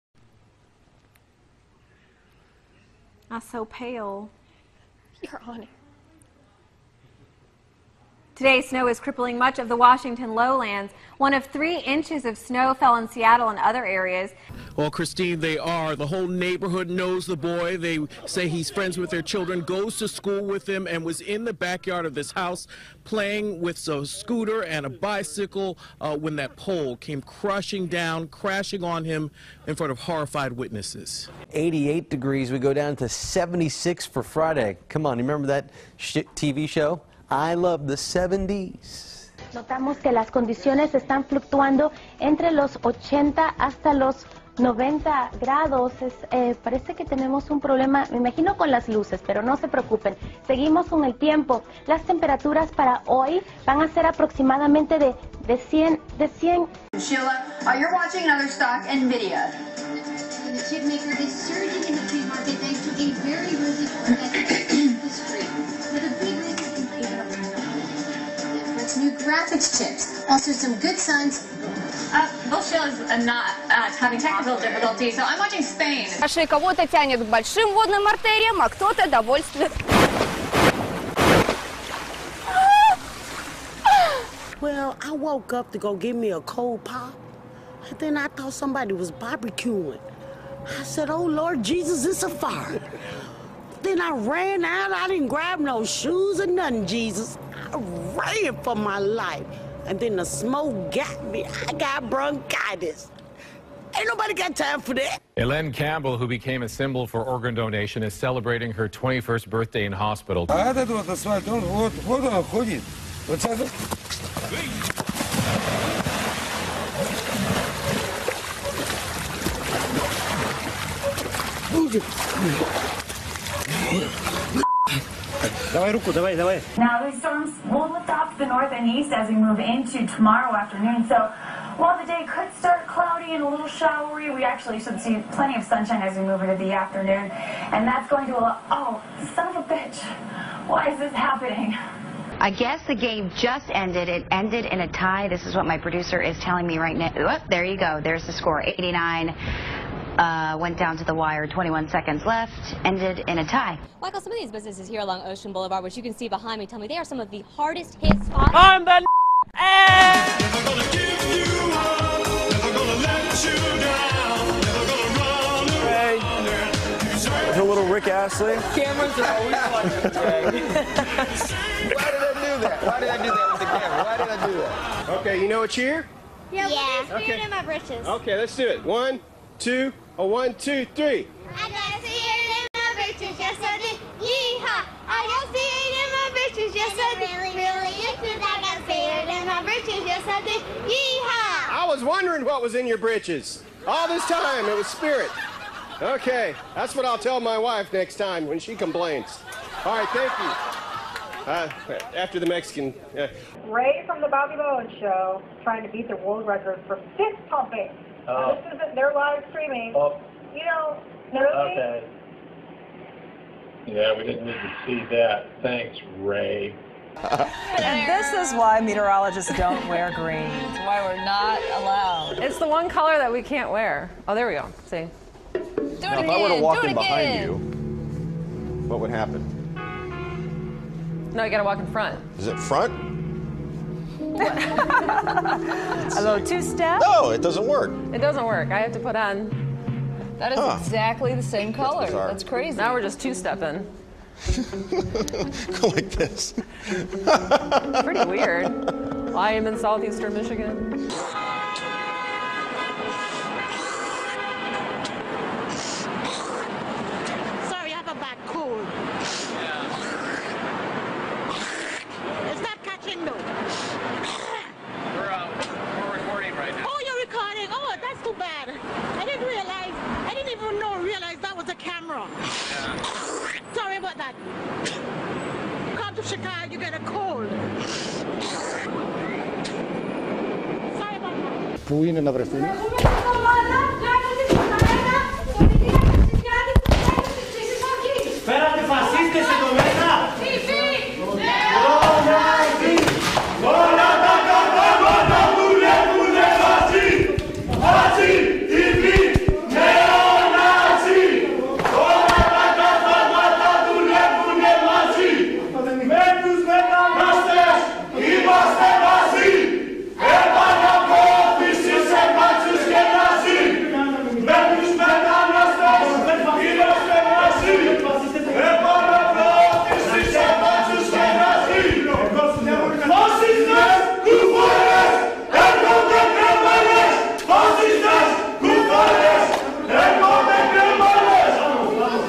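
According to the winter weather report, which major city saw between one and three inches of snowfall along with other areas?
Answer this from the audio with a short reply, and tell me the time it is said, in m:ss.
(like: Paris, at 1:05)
Seattle, at 0:13.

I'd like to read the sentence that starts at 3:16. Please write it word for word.
Okay, that's what I'll tell my wife next time when she complains.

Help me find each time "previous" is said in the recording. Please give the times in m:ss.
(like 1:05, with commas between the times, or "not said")
not said.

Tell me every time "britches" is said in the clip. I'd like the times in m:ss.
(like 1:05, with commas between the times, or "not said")
2:57, 3:12.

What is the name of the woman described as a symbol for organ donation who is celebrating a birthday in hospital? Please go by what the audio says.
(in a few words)
Elaine Campbell.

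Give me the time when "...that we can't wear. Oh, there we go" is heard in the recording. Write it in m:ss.
3:43.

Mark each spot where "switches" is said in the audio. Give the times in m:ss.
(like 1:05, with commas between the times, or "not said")
not said.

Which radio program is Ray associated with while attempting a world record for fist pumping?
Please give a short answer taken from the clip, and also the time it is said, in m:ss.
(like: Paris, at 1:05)
The Bobby Bones Show, at 3:24.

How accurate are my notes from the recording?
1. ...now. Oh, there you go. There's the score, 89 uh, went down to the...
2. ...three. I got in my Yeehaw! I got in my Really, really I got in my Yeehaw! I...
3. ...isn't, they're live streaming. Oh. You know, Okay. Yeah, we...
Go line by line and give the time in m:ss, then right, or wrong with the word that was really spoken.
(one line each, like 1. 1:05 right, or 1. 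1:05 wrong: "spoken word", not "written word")
1. 2:26 right
2. 3:00 right
3. 3:28 right.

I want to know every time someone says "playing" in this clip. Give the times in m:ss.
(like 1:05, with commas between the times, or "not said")
0:23.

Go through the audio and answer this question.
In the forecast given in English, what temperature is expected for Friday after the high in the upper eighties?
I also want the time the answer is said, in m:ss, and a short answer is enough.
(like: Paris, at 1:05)
76, at 0:33.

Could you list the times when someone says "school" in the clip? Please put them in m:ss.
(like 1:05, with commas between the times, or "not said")
0:20.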